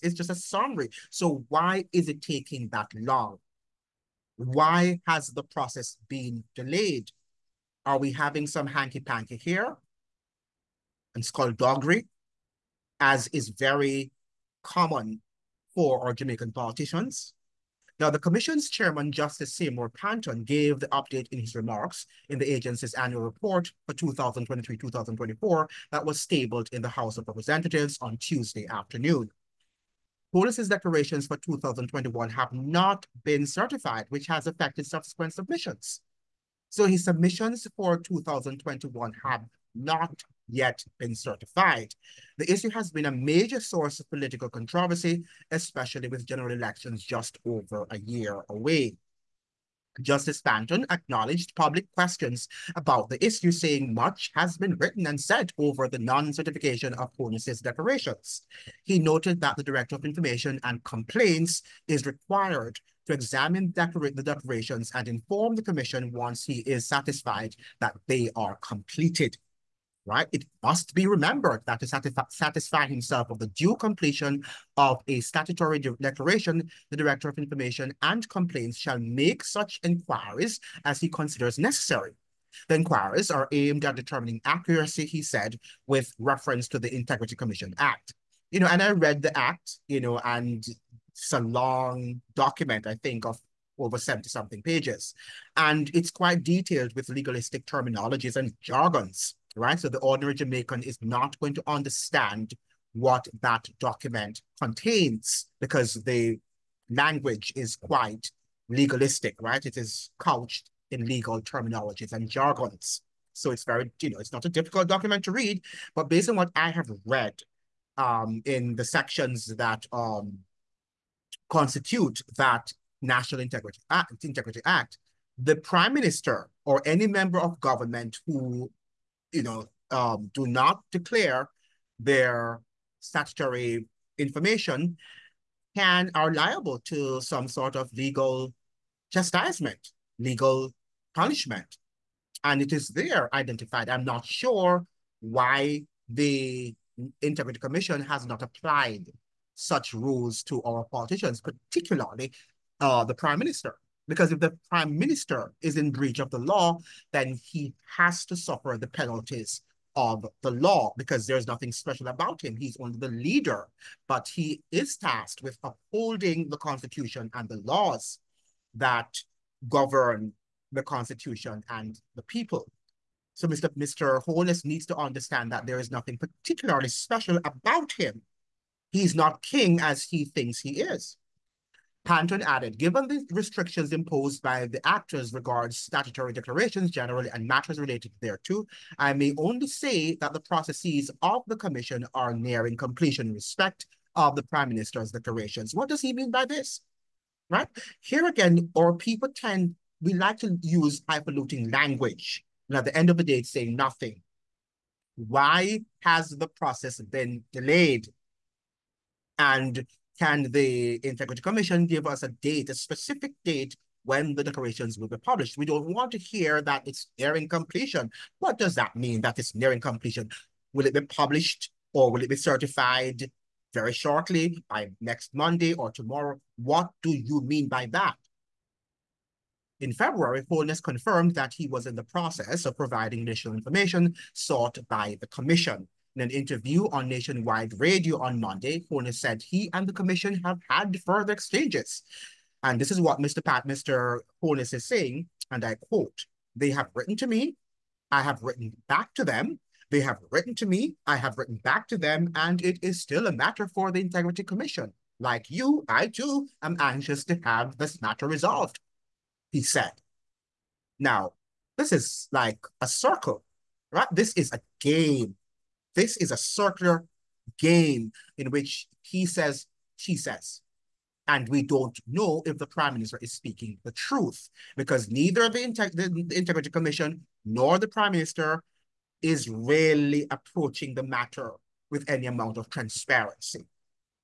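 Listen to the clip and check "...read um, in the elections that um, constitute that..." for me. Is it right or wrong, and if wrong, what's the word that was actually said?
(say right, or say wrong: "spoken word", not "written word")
wrong: "sections", not "elections".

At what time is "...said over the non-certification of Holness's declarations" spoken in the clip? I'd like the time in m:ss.
0:55.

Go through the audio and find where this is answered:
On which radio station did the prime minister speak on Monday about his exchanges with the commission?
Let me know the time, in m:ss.
3:57.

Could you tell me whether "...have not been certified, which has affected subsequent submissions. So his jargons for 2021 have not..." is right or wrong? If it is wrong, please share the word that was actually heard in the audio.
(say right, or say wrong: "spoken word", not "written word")
wrong: "submissions", not "jargons".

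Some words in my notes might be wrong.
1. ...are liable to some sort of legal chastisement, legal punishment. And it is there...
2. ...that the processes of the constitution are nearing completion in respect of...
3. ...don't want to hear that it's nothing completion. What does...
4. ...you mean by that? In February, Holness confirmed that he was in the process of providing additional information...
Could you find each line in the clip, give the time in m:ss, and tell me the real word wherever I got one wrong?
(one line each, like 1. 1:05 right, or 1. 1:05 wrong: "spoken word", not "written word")
1. 2:16 right
2. 3:10 wrong: "commission", not "constitution"
3. 3:35 wrong: "nearing", not "nothing"
4. 3:47 right.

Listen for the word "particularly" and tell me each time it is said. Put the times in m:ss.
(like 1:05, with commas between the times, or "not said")
2:31, 2:56.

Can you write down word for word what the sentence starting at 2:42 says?
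He's only the leader, but he is tasked with upholding the constitution and the laws that govern the constitution and the people.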